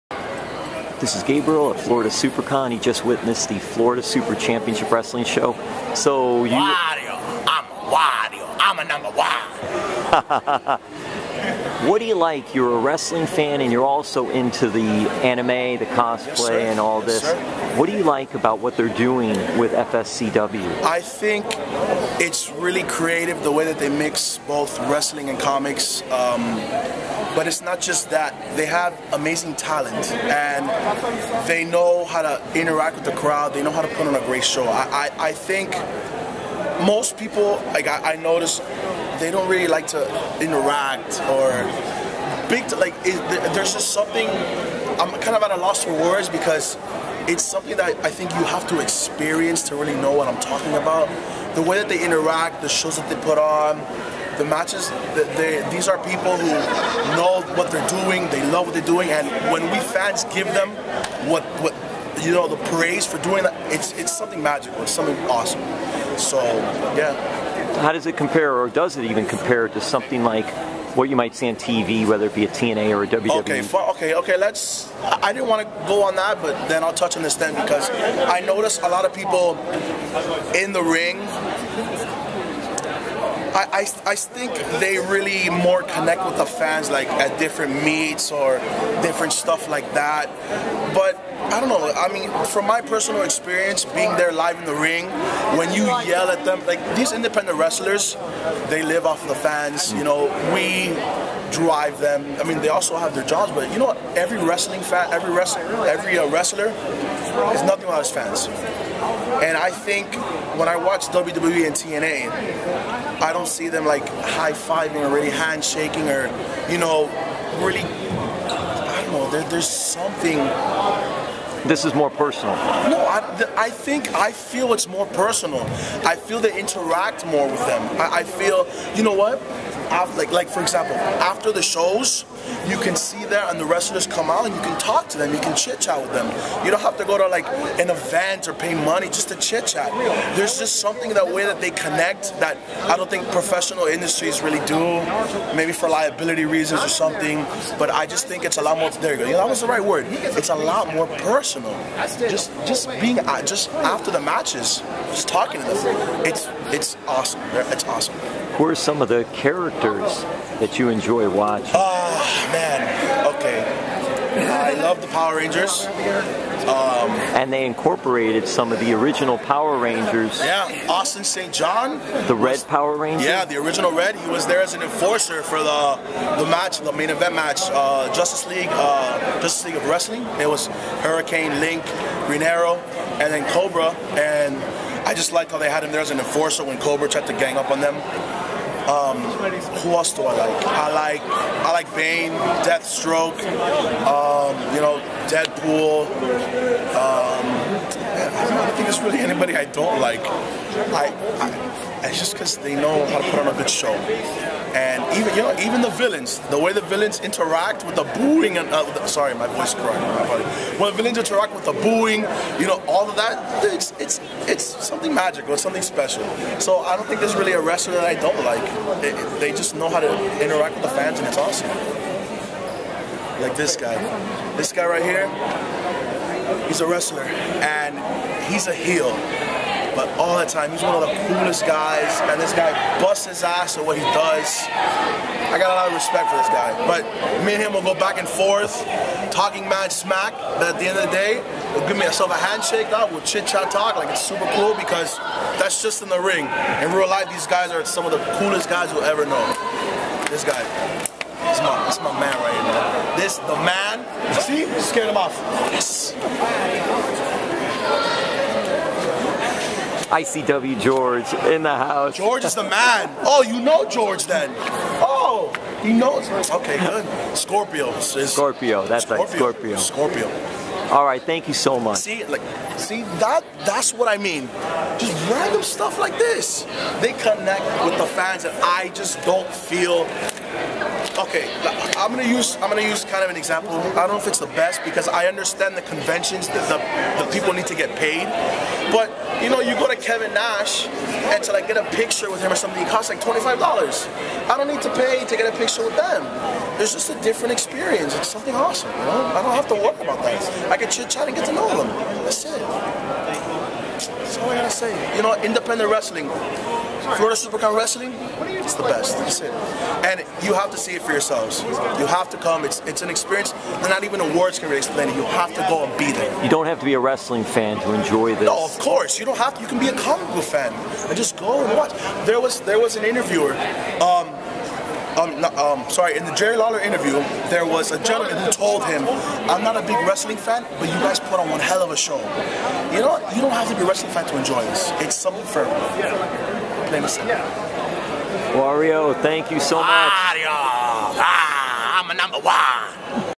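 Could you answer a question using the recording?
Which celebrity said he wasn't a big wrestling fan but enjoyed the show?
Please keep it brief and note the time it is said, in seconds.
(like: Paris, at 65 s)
Jerry Lawler, at 326 s.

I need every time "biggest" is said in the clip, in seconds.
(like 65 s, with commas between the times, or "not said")
not said.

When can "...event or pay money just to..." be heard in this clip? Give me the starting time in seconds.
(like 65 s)
137 s.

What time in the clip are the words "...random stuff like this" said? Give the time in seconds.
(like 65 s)
275 s.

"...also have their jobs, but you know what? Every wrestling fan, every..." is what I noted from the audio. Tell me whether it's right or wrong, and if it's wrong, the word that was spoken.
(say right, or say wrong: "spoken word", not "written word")
right.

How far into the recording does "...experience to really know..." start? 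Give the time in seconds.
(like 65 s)
48 s.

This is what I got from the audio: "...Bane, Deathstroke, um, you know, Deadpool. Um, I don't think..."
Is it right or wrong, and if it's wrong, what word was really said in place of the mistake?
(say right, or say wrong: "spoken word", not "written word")
right.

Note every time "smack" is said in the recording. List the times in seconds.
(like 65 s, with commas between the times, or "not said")
239 s.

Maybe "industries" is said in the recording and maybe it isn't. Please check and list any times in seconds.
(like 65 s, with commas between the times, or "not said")
143 s.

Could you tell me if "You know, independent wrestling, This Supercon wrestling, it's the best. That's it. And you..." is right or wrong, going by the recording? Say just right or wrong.
wrong.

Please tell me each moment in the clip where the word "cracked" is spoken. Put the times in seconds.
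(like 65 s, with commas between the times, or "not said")
209 s.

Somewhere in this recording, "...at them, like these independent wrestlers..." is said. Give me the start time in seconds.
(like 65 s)
96 s.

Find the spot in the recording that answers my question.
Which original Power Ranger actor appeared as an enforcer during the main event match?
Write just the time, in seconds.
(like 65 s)
170 s.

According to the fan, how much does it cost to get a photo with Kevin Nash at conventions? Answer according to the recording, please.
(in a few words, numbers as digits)
$25.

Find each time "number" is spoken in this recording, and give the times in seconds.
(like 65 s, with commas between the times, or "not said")
8 s, 342 s.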